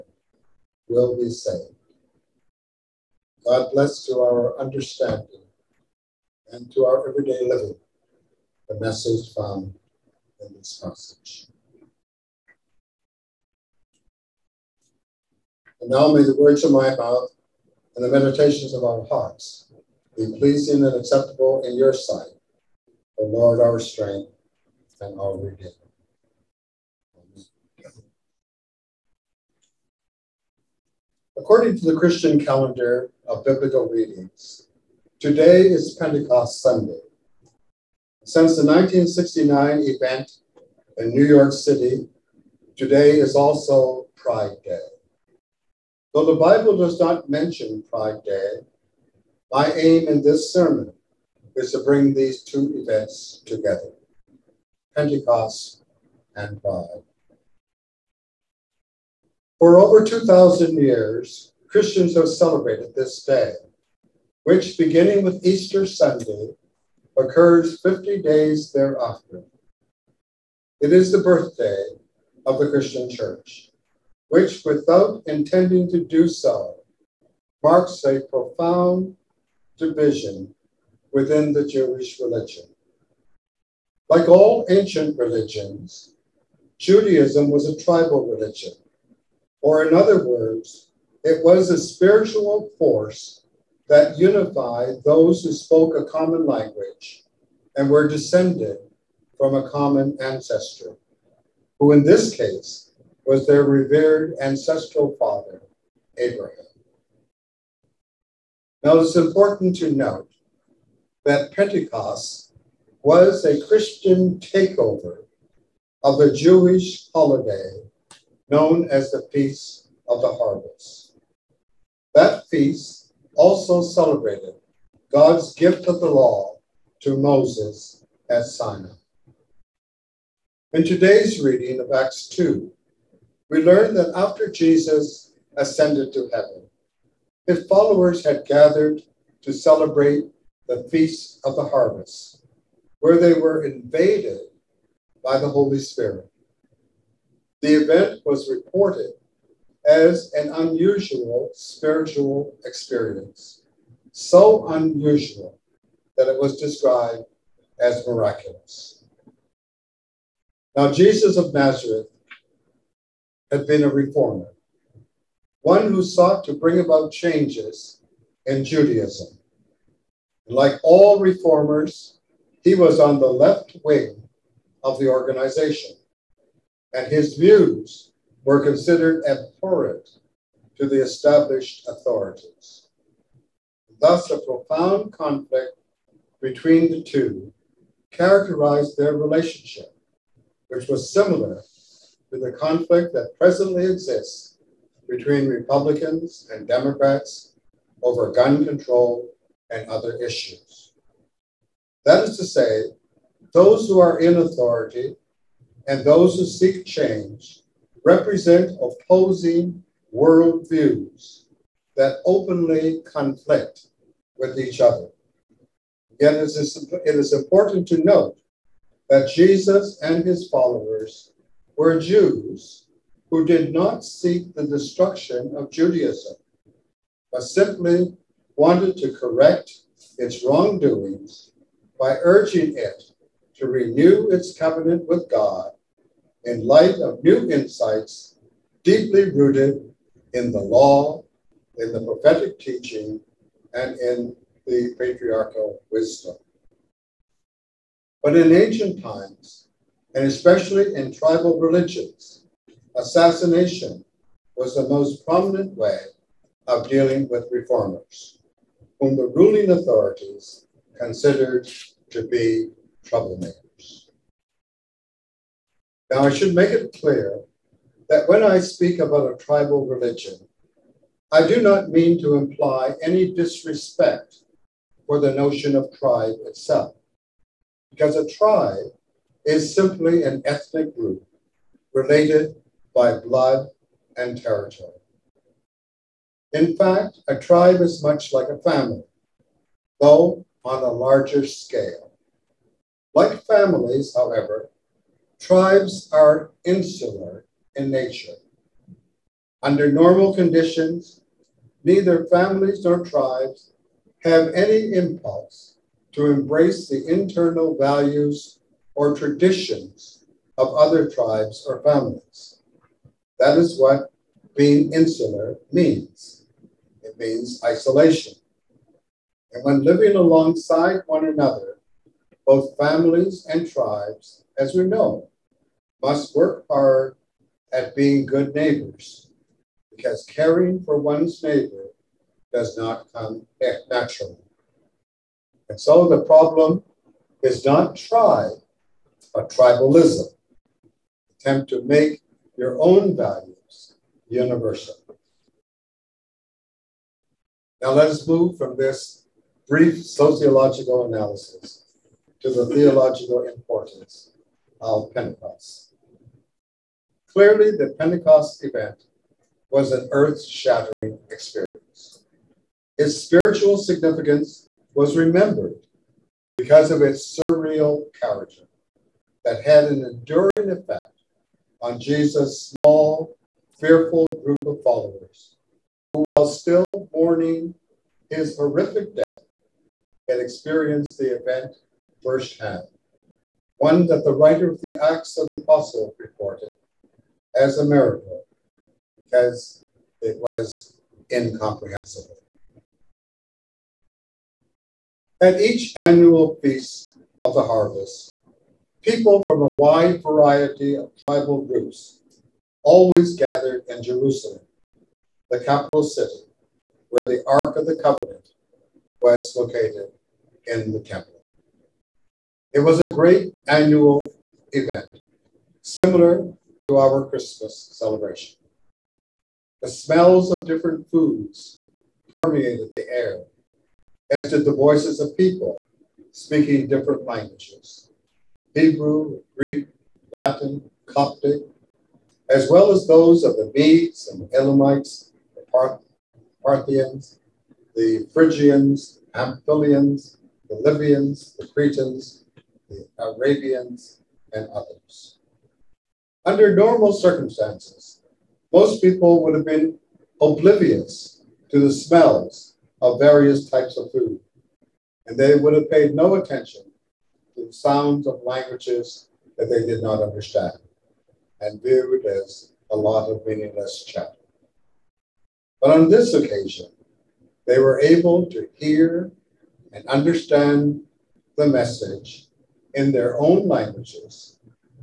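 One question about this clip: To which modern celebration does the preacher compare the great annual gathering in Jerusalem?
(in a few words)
Christmas.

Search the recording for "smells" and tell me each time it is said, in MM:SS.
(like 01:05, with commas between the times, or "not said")
06:59, 07:31.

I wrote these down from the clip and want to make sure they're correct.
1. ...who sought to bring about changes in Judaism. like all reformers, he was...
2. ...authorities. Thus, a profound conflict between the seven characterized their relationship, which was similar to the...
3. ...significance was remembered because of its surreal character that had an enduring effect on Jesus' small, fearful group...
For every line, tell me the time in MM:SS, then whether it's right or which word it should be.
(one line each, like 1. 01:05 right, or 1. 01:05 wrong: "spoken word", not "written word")
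1. 02:45 right
2. 03:01 wrong: "two", not "seven"
3. 06:03 right.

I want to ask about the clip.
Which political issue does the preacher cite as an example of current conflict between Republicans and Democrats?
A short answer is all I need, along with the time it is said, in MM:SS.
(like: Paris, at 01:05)
gun control, at 03:18.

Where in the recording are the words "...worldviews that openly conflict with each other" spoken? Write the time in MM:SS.
03:30.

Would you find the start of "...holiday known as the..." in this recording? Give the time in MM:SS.
01:57.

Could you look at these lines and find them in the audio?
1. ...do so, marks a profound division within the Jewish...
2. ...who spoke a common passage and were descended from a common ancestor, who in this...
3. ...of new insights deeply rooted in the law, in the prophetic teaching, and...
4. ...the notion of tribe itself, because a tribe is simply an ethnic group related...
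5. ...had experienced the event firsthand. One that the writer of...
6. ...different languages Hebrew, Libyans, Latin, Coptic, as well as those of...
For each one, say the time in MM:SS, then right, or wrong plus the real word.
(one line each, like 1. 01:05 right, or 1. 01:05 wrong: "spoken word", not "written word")
1. 01:16 right
2. 01:35 wrong: "language", not "passage"
3. 03:56 right
4. 04:35 right
5. 06:20 right
6. 07:06 wrong: "Greek", not "Libyans".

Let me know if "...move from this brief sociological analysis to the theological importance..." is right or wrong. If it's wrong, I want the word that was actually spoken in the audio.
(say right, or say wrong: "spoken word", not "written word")
right.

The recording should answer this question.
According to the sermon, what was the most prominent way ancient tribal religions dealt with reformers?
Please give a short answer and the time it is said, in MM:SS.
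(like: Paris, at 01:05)
assassination, at 04:12.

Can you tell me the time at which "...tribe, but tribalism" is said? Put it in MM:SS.
05:37.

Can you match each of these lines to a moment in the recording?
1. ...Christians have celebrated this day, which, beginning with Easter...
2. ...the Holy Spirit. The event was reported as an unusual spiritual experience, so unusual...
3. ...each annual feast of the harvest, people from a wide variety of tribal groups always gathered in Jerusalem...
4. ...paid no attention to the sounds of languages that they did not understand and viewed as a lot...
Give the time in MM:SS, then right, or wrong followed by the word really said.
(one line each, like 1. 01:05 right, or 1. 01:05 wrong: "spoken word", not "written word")
1. 01:01 right
2. 02:25 right
3. 06:35 right
4. 07:35 right.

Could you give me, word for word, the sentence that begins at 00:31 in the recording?
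According to the Christian calendar of biblical readings, today is Pentecost Sunday.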